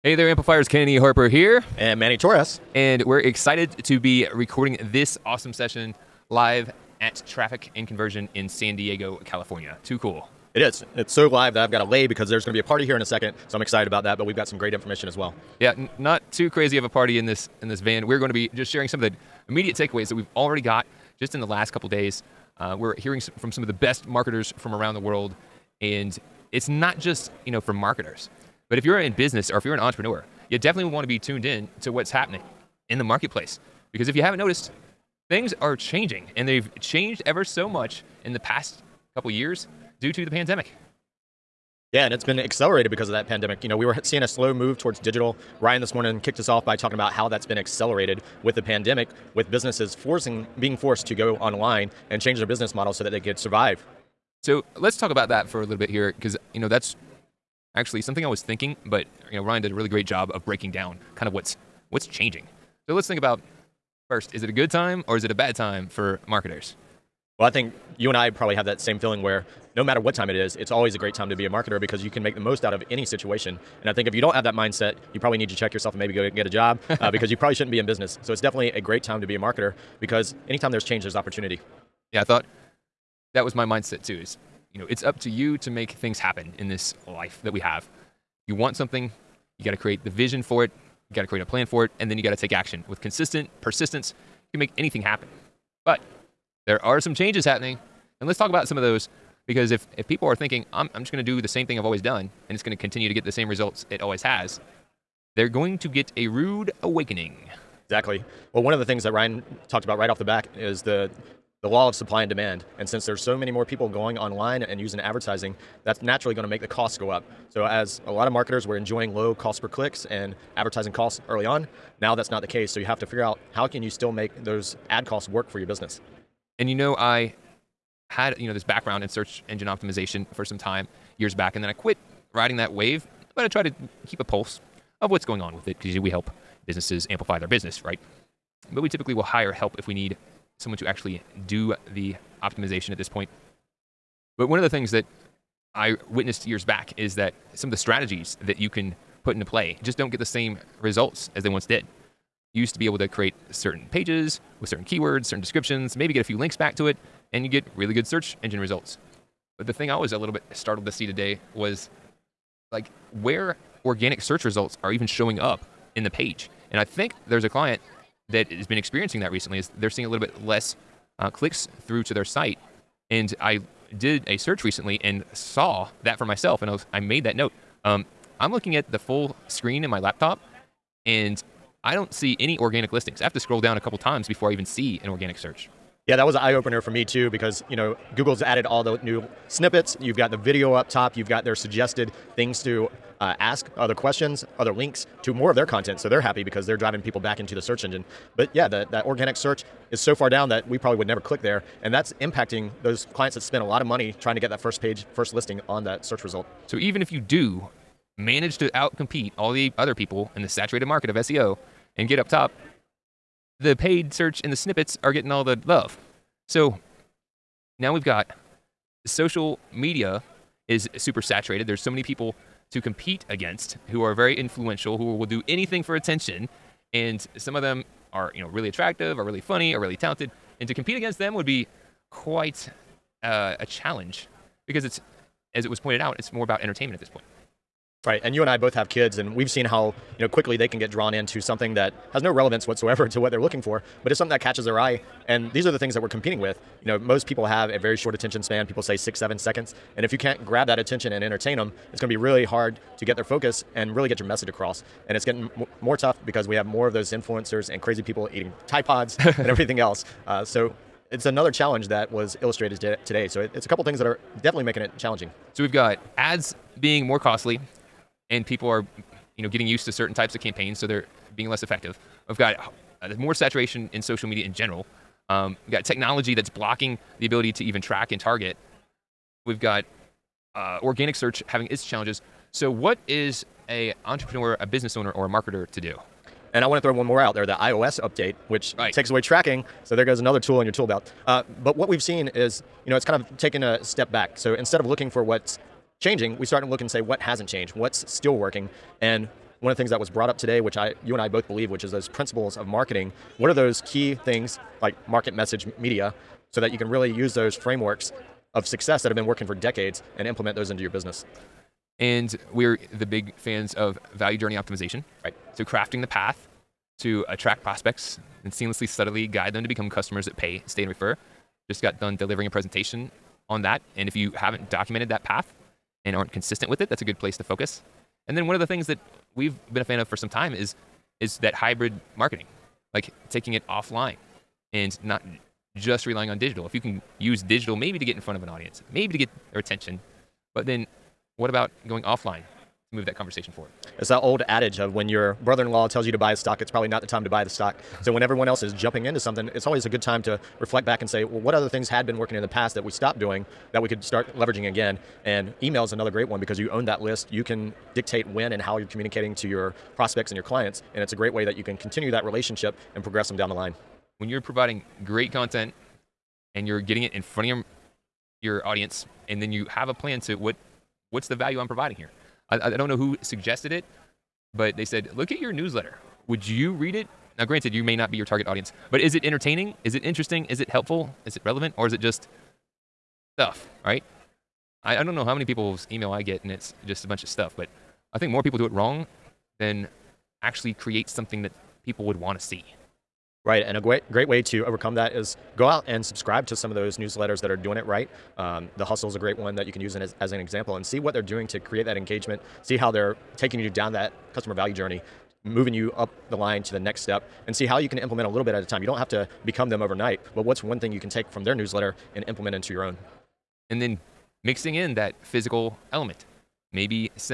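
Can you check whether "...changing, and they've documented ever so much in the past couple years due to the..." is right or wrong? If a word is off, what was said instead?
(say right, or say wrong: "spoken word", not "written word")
wrong: "changed", not "documented".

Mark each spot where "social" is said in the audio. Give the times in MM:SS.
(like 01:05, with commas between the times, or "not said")
03:39, 04:34.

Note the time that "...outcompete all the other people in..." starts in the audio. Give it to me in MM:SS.
03:28.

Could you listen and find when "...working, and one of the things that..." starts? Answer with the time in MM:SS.
04:58.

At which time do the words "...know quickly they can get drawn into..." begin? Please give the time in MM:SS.
04:00.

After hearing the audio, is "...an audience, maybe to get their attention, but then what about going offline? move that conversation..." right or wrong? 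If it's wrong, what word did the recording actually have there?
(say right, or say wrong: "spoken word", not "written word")
right.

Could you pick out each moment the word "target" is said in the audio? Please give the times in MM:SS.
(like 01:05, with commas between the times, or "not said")
04:38, 06:18.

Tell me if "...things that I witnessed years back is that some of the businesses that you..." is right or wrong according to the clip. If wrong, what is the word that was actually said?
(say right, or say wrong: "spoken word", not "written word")
wrong: "strategies", not "businesses".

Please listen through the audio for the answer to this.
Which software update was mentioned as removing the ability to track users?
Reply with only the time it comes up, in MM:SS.
04:47.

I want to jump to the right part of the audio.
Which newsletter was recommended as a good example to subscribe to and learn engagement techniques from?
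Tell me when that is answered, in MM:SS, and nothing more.
06:38.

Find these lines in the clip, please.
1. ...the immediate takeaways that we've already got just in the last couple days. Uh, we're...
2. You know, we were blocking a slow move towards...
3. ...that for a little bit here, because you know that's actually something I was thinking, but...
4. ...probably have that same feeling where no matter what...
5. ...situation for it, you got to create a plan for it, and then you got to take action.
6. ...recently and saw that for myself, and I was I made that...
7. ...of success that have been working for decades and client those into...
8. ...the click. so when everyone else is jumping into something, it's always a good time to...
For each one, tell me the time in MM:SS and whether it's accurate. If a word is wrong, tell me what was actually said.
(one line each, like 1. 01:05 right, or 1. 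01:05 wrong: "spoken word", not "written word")
1. 00:19 right
2. 00:43 wrong: "seeing", not "blocking"
3. 00:55 right
4. 01:08 right
5. 01:30 wrong: "vision", not "situation"
6. 02:54 right
7. 05:08 wrong: "implement", not "client"
8. 05:47 wrong: "stock", not "click".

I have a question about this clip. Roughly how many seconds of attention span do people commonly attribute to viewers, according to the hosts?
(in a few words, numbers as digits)
6 or 7 seconds.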